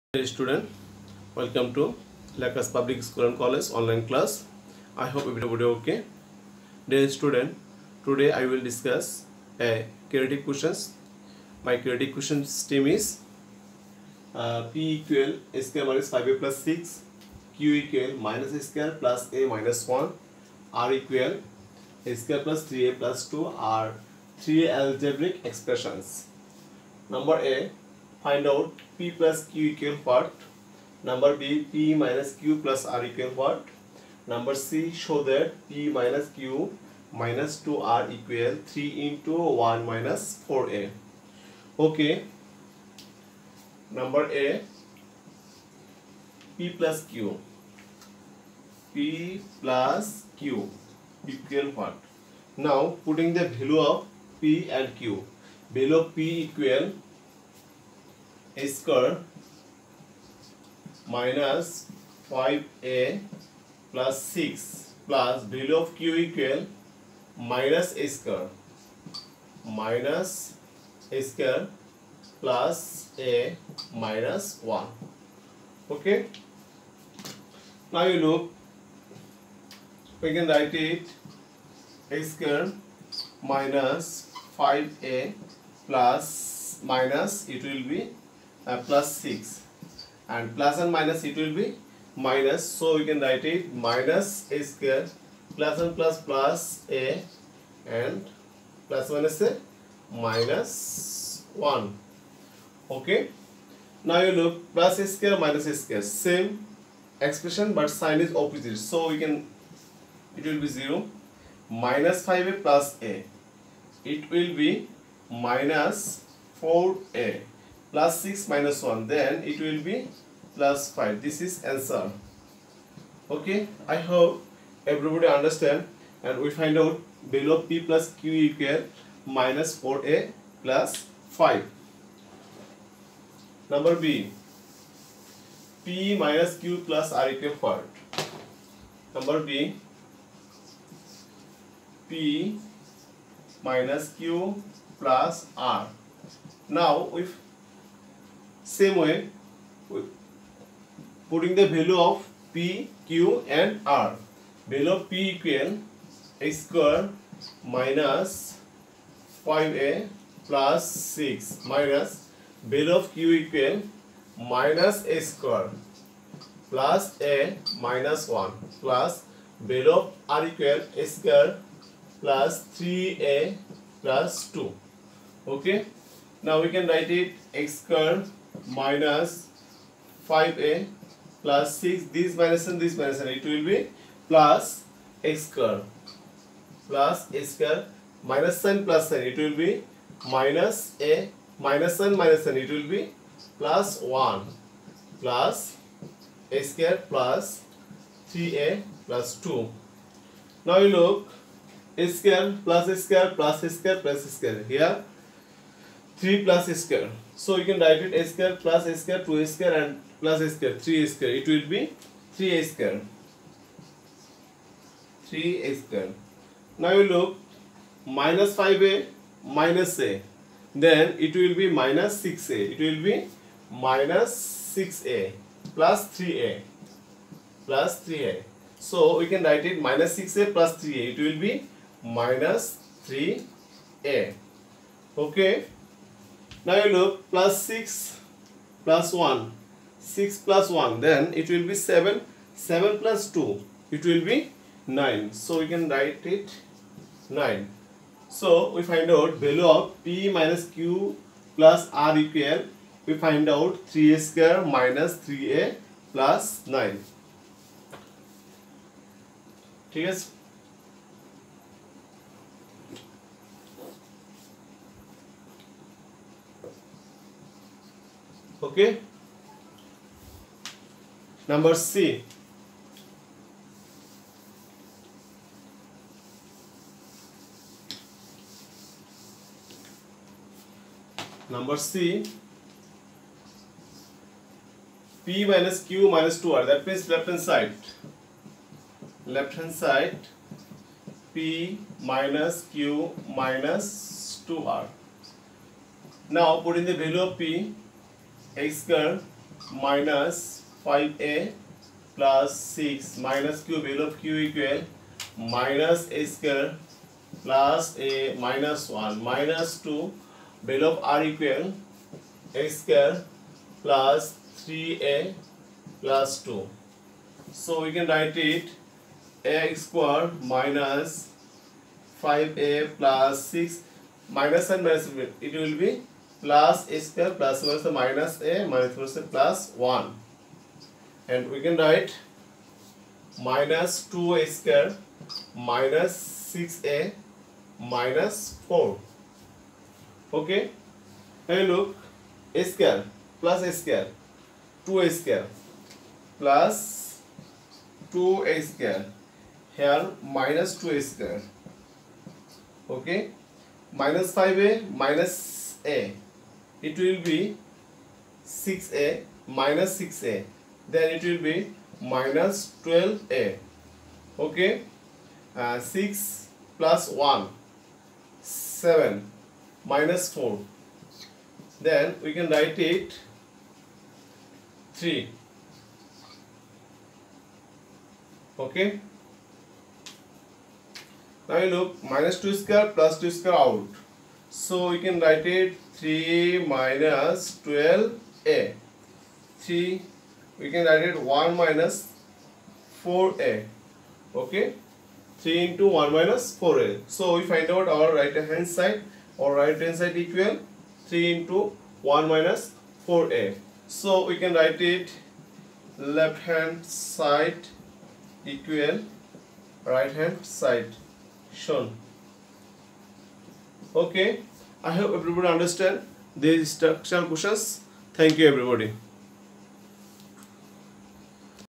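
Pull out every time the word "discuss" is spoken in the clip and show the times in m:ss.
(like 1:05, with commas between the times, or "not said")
0:08.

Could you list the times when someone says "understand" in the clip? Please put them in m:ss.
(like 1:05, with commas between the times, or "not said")
2:05, 6:55.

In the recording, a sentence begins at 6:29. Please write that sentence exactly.
3 we can write it 1 minus 4a.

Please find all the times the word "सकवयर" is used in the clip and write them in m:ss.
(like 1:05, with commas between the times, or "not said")
5:06, 5:12.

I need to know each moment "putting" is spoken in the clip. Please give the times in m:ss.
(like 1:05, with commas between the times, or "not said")
0:53, 2:31.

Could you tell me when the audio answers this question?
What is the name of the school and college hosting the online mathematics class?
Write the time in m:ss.
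0:02.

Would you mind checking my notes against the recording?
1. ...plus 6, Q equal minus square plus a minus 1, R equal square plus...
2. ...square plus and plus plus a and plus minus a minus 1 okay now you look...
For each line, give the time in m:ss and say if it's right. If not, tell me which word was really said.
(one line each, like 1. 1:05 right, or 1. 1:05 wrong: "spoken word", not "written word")
1. 0:16 right
2. 1:34 right.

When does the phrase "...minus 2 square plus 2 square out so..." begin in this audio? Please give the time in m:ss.
6:22.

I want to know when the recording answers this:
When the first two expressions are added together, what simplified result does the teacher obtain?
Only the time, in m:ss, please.
2:09.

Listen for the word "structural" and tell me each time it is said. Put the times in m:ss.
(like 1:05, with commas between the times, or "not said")
6:56.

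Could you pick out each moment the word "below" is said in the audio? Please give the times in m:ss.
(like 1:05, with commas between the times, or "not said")
0:55, 2:07.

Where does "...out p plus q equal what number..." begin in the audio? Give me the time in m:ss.
0:28.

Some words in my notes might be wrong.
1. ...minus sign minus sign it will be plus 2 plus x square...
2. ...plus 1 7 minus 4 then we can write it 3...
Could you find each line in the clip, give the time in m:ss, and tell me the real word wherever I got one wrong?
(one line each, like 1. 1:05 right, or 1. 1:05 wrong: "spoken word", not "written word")
1. 3:11 wrong: "1", not "2"
2. 6:06 right.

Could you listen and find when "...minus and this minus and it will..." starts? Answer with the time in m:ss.
3:02.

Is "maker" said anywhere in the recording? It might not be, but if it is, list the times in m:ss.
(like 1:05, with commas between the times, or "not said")
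not said.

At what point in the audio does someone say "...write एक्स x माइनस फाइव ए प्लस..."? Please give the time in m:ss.
5:18.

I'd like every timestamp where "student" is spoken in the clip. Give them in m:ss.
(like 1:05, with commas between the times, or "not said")
0:00, 0:07.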